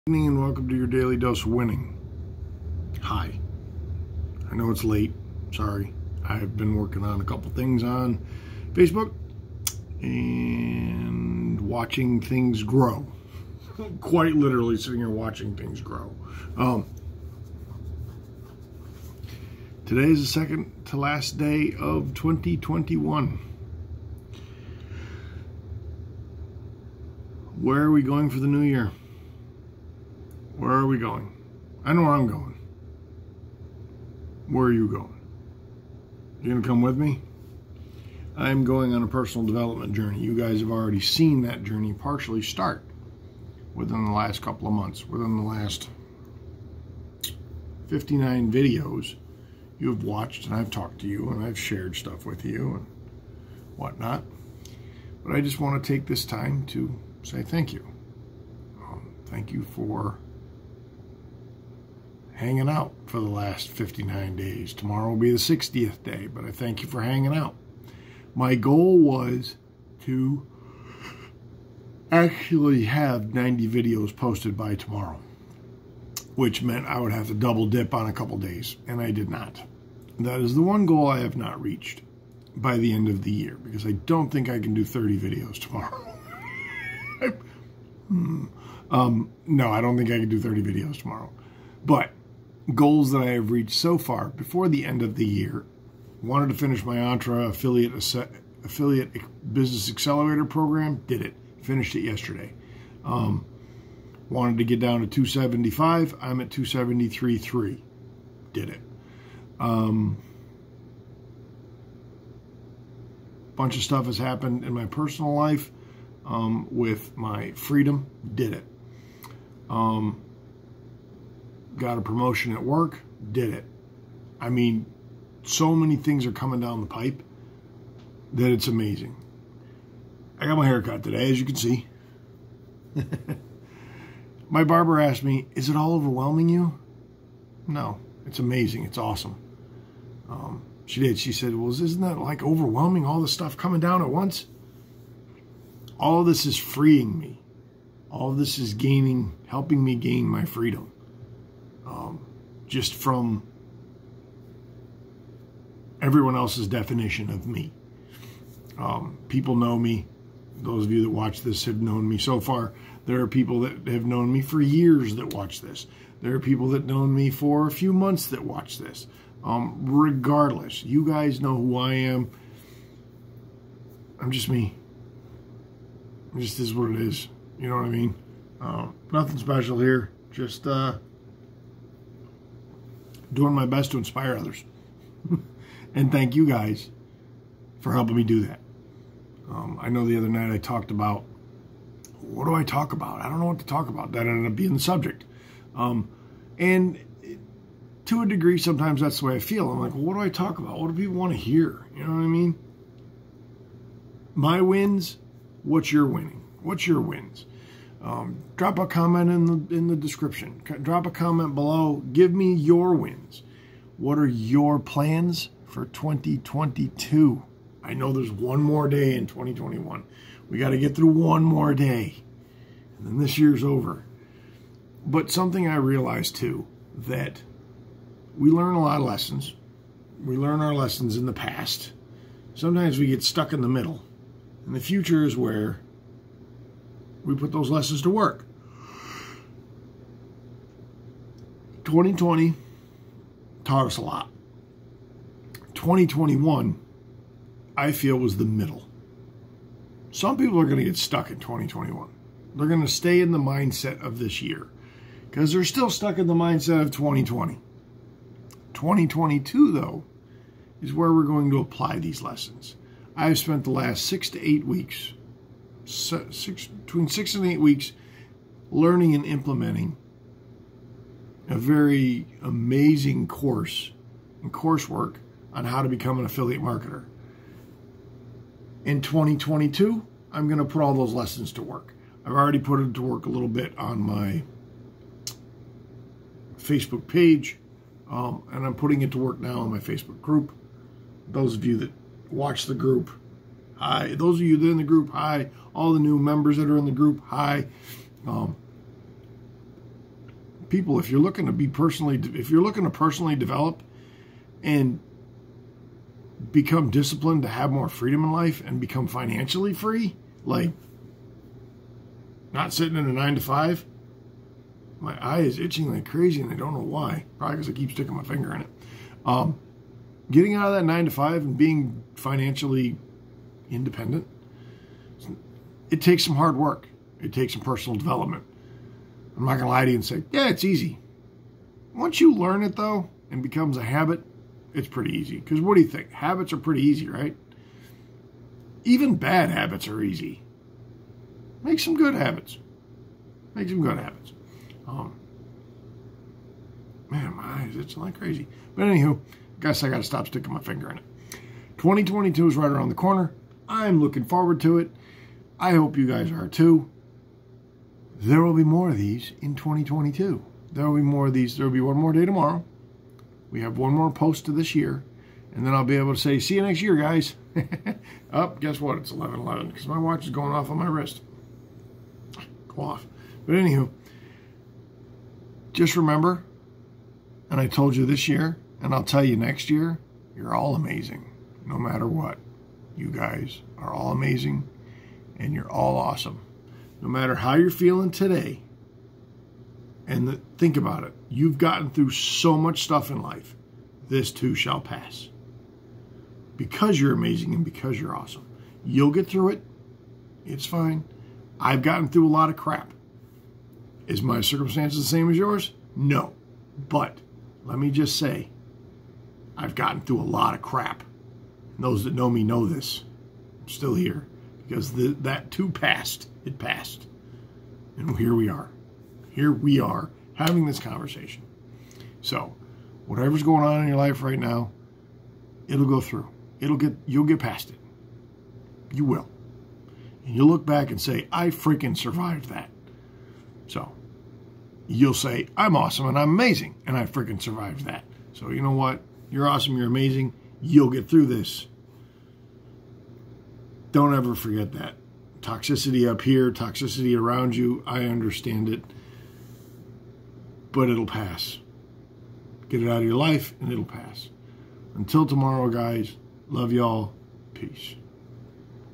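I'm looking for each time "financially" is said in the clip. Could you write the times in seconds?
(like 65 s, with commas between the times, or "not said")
309 s, 322 s.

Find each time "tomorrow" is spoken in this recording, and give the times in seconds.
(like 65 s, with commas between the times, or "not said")
64 s, 74 s, 85 s, 90 s, 362 s, 455 s.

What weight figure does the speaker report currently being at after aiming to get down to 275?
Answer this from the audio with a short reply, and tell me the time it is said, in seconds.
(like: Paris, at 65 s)
273.3, at 106 s.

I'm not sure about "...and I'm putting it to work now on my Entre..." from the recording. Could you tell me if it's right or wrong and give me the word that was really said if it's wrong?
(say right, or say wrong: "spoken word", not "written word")
wrong: "Facebook", not "Entre".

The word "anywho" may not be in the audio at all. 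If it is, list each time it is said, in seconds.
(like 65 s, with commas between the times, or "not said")
348 s, 373 s.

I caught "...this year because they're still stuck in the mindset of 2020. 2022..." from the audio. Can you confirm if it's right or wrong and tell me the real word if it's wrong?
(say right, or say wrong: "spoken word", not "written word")
right.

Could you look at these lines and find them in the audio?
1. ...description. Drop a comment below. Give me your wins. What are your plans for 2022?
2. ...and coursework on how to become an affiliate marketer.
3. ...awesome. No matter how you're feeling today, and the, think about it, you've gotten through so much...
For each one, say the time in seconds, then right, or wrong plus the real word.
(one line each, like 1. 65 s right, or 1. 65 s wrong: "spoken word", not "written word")
1. 209 s right
2. 274 s right
3. 385 s right.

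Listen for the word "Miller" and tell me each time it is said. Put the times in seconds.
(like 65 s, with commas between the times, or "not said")
not said.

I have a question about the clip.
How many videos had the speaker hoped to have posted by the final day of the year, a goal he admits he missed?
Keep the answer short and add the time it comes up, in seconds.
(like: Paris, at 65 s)
90, at 73 s.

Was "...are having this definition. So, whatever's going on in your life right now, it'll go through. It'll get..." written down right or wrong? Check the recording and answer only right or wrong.
wrong.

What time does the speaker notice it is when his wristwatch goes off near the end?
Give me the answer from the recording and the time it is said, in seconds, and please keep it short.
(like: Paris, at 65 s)
11:11, at 369 s.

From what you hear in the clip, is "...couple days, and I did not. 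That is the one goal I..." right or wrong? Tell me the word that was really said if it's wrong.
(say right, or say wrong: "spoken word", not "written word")
right.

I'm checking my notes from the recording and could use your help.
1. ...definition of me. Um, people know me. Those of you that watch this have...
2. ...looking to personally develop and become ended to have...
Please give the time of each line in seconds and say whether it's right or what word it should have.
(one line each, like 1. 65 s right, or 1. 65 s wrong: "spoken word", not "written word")
1. 156 s right
2. 302 s wrong: "disciplined", not "ended".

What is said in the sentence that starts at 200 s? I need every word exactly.
What do people want to hear?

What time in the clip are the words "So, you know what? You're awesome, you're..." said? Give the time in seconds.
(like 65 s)
438 s.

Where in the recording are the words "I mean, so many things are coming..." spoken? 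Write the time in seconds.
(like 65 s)
124 s.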